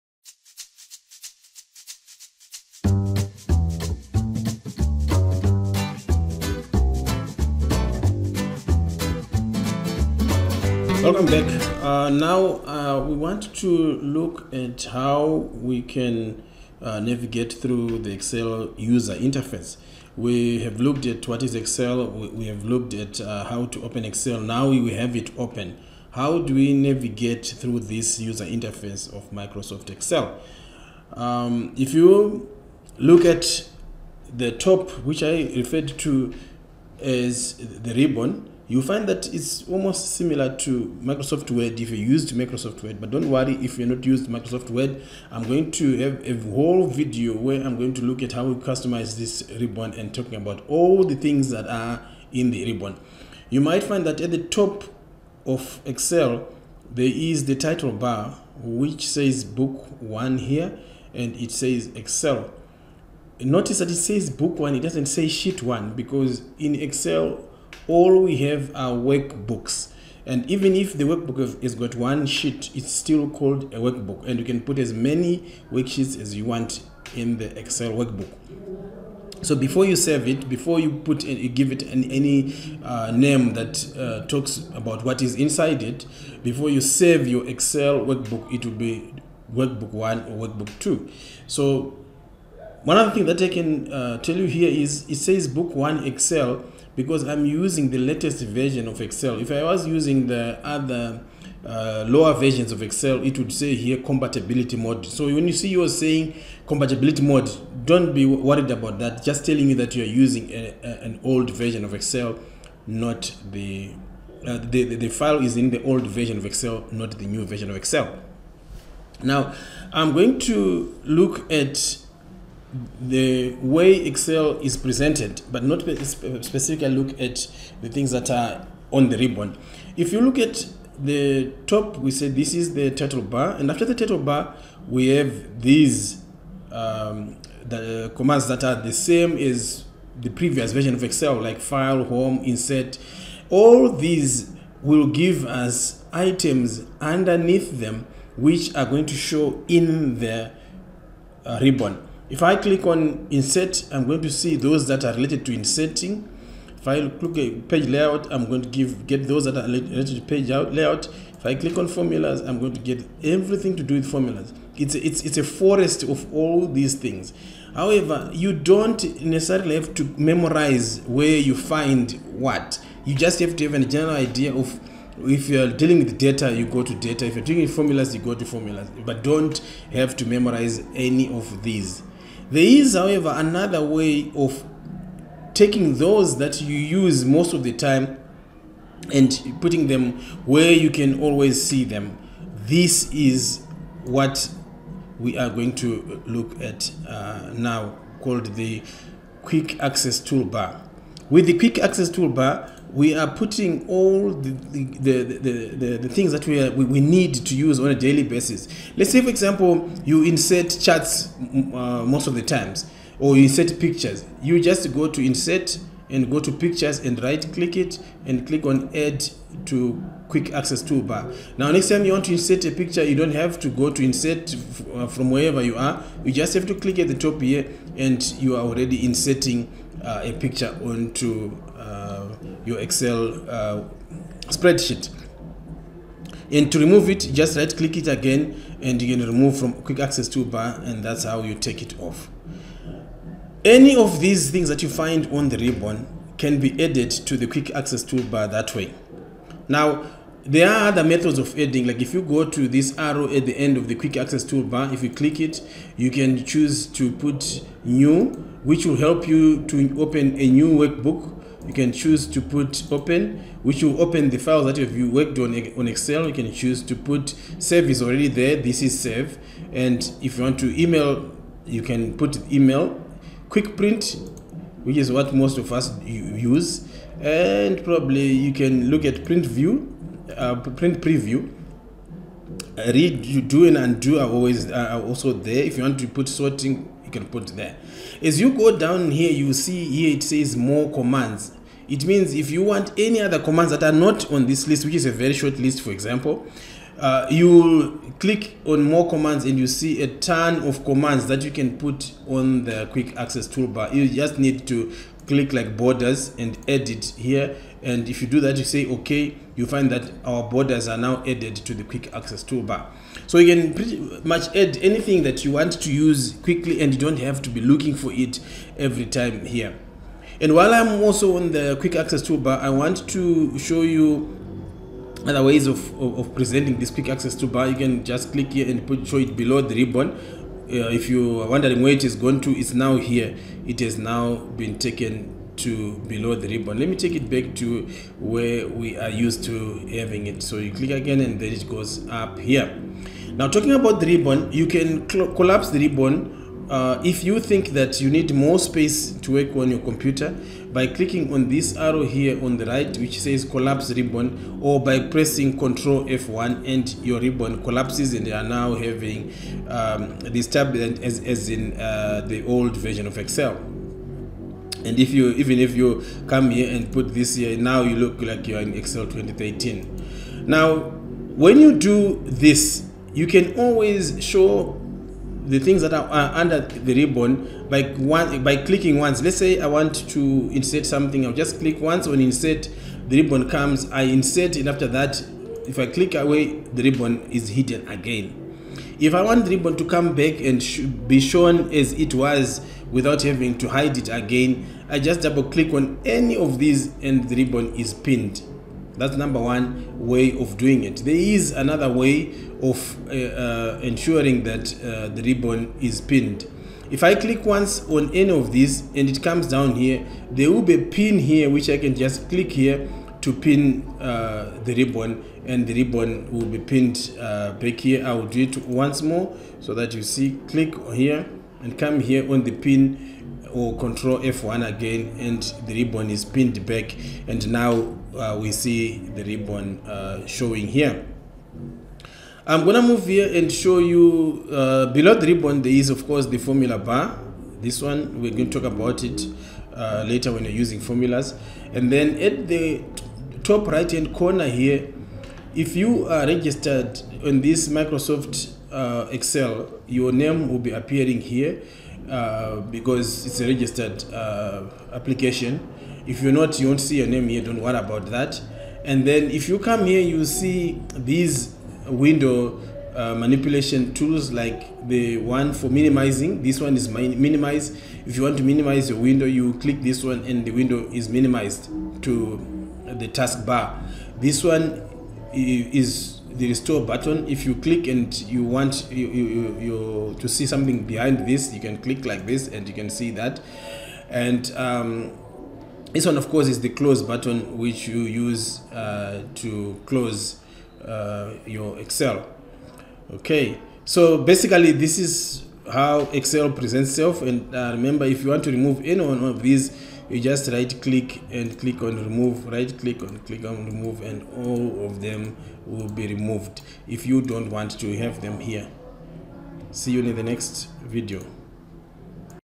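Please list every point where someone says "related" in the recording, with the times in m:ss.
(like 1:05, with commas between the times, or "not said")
2:35, 2:39.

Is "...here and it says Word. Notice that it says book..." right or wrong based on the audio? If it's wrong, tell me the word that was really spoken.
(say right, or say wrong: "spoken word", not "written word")
wrong: "Excel", not "Word".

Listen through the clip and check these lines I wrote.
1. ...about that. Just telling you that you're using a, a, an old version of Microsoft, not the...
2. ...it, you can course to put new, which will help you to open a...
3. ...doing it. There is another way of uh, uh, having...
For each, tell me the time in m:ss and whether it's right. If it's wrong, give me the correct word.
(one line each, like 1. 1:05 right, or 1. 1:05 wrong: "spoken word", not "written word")
1. 1:48 wrong: "Excel", not "Microsoft"
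2. 4:15 wrong: "choose", not "course"
3. 6:40 wrong: "ensuring", not "having".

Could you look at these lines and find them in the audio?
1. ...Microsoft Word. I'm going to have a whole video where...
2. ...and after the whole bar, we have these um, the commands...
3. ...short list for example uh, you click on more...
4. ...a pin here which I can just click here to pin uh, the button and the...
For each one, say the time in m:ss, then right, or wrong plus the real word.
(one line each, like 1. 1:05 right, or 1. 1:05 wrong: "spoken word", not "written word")
1. 0:44 right
2. 2:13 wrong: "title", not "whole"
3. 4:55 right
4. 6:50 wrong: "ribbon", not "button".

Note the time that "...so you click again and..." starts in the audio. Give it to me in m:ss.
5:40.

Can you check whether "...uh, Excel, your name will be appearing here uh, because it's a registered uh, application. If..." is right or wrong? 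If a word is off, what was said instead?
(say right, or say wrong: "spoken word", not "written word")
right.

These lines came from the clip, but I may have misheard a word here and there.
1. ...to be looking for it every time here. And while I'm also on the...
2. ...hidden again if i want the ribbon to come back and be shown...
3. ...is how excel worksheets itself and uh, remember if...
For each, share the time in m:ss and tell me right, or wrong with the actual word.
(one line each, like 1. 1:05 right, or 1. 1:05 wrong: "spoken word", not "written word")
1. 5:17 right
2. 6:27 right
3. 8:14 wrong: "presents", not "worksheets".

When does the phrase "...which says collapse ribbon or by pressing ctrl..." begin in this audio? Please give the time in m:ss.
5:52.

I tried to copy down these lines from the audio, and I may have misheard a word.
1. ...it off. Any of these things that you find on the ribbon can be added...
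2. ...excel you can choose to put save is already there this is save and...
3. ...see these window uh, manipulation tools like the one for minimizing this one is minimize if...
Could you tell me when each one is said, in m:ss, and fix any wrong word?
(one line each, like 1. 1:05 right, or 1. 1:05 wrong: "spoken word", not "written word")
1. 4:01 right
2. 4:25 right
3. 7:40 right.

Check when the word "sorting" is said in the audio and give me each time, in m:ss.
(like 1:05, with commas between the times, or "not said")
4:46.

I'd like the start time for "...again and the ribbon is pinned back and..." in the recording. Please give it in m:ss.
7:04.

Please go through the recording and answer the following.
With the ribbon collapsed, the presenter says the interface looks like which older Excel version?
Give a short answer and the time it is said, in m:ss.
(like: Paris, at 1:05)
Excel 2013, at 6:08.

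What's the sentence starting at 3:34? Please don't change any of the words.
You just go to insert and go to pictures and right click it and click on add to quick access toolbar.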